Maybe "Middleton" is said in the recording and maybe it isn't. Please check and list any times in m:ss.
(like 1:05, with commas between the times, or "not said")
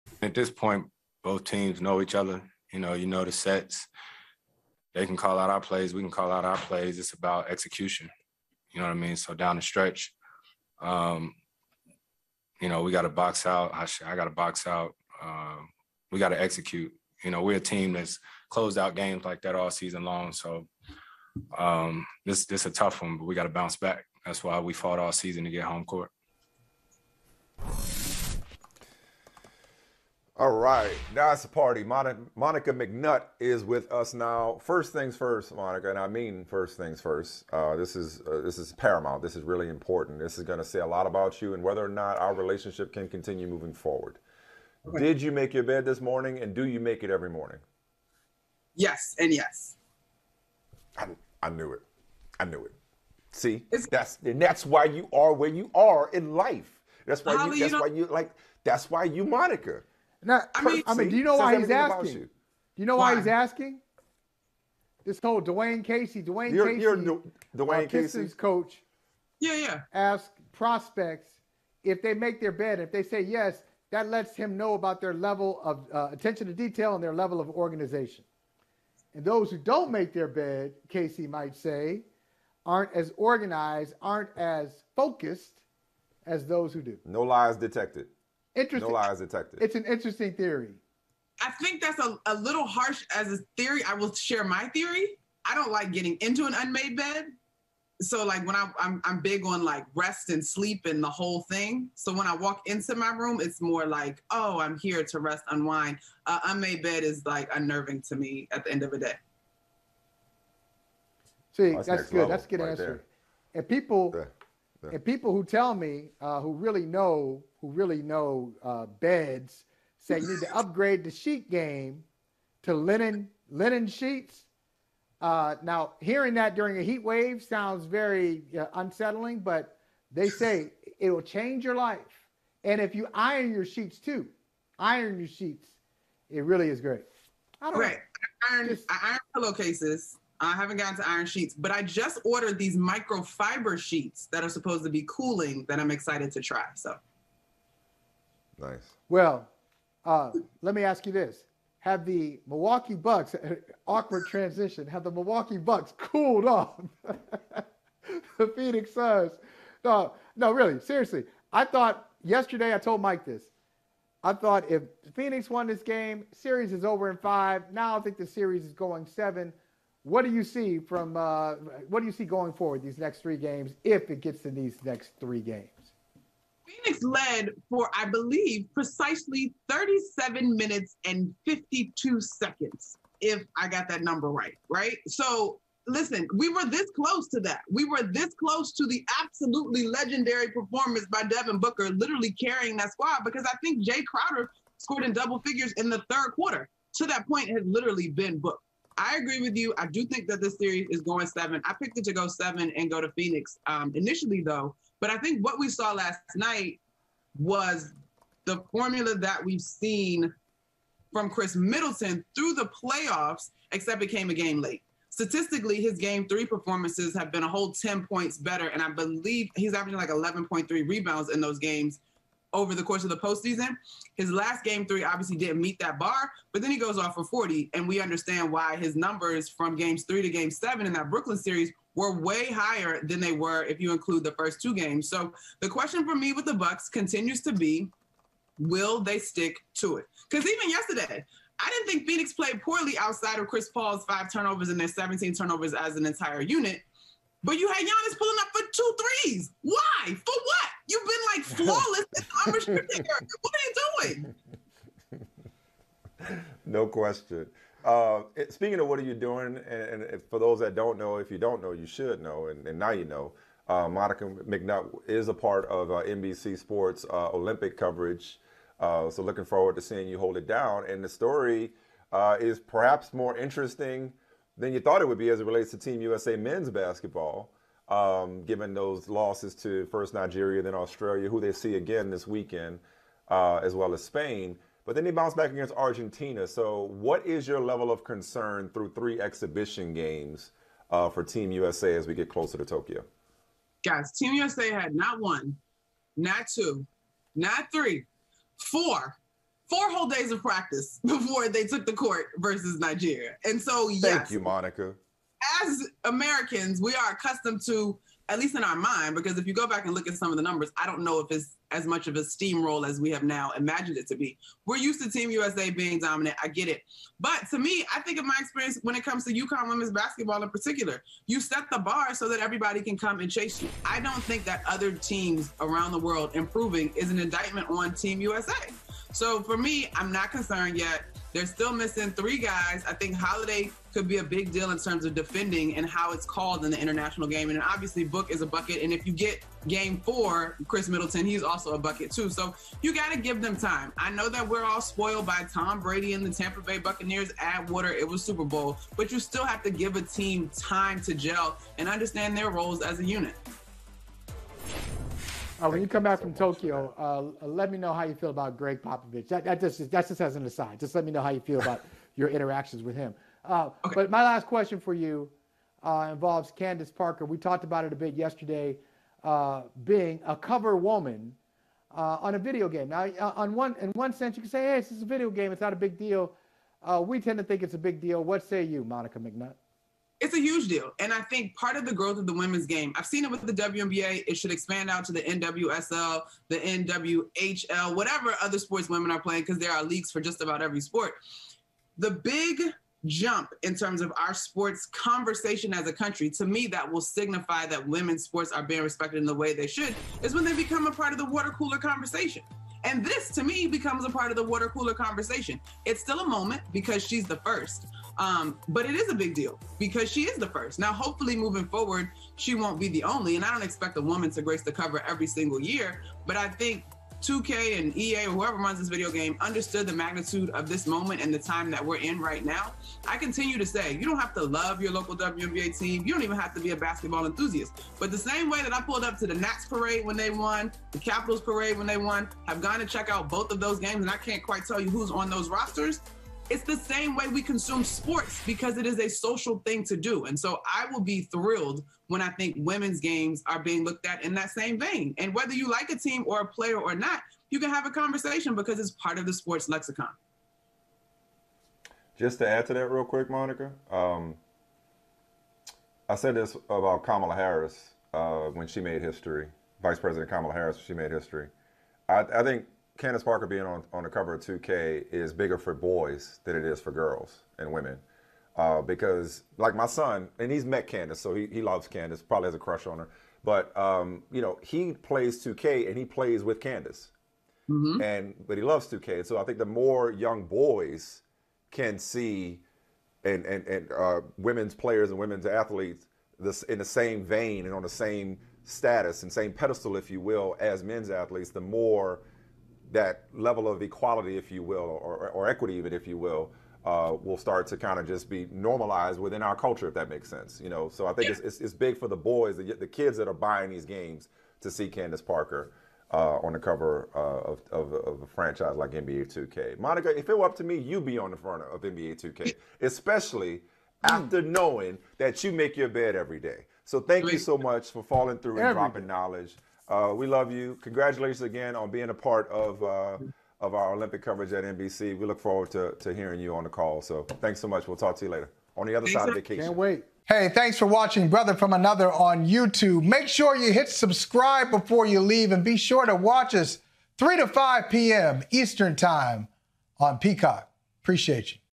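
3:31, 5:40.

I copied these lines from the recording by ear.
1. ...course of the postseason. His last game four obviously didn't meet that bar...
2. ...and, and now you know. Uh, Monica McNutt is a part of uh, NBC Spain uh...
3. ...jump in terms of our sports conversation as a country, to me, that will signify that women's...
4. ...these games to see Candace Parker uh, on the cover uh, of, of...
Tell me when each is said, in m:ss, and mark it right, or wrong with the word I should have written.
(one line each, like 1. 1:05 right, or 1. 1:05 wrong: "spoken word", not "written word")
1. 3:42 wrong: "three", not "four"
2. 4:22 wrong: "Sports", not "Spain"
3. 6:33 right
4. 8:23 right.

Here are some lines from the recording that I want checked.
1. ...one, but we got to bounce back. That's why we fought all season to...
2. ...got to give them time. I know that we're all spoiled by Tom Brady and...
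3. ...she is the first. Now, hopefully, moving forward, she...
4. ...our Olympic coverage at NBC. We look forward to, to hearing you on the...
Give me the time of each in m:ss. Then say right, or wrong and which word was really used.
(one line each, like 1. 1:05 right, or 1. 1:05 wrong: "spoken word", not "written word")
1. 0:23 right
2. 5:42 right
3. 6:50 right
4. 8:43 right.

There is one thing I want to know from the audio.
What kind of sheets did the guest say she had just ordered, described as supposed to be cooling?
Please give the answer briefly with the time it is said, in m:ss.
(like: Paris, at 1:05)
Microfiber sheets, at 2:22.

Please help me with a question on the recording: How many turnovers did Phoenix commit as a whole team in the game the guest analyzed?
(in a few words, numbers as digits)
17.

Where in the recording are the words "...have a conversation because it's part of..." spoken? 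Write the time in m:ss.
7:27.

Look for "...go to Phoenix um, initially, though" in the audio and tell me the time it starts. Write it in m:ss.
3:22.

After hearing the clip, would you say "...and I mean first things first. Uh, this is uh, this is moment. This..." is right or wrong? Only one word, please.
wrong.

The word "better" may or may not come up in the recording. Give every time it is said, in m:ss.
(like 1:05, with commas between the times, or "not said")
3:38.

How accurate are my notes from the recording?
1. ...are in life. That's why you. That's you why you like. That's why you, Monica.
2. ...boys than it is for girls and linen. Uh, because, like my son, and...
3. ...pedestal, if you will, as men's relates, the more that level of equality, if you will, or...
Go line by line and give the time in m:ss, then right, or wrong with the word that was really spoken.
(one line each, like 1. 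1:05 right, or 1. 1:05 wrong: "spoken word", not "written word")
1. 0:55 right
2. 7:45 wrong: "women", not "linen"
3. 8:09 wrong: "athletes", not "relates".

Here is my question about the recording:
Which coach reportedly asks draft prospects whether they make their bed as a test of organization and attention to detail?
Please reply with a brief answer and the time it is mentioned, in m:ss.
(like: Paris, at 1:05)
Dwane Casey, at 1:05.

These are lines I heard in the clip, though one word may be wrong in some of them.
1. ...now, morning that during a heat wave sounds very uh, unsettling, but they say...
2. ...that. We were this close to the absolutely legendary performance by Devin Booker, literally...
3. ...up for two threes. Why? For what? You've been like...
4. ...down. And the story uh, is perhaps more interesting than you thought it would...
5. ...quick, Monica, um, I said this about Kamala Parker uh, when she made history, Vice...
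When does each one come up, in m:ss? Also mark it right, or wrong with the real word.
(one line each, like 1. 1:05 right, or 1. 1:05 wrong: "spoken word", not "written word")
1. 2:05 wrong: "hearing", not "morning"
2. 3:07 right
3. 4:08 right
4. 4:30 right
5. 7:33 wrong: "Harris", not "Parker".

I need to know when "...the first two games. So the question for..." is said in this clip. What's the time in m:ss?
3:54.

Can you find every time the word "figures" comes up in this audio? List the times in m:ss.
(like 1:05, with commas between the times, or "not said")
3:15.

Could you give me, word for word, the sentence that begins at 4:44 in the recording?
But then they bounce back against Argentina.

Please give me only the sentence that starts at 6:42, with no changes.
And this, to me, becomes a part of the water cooler conversation.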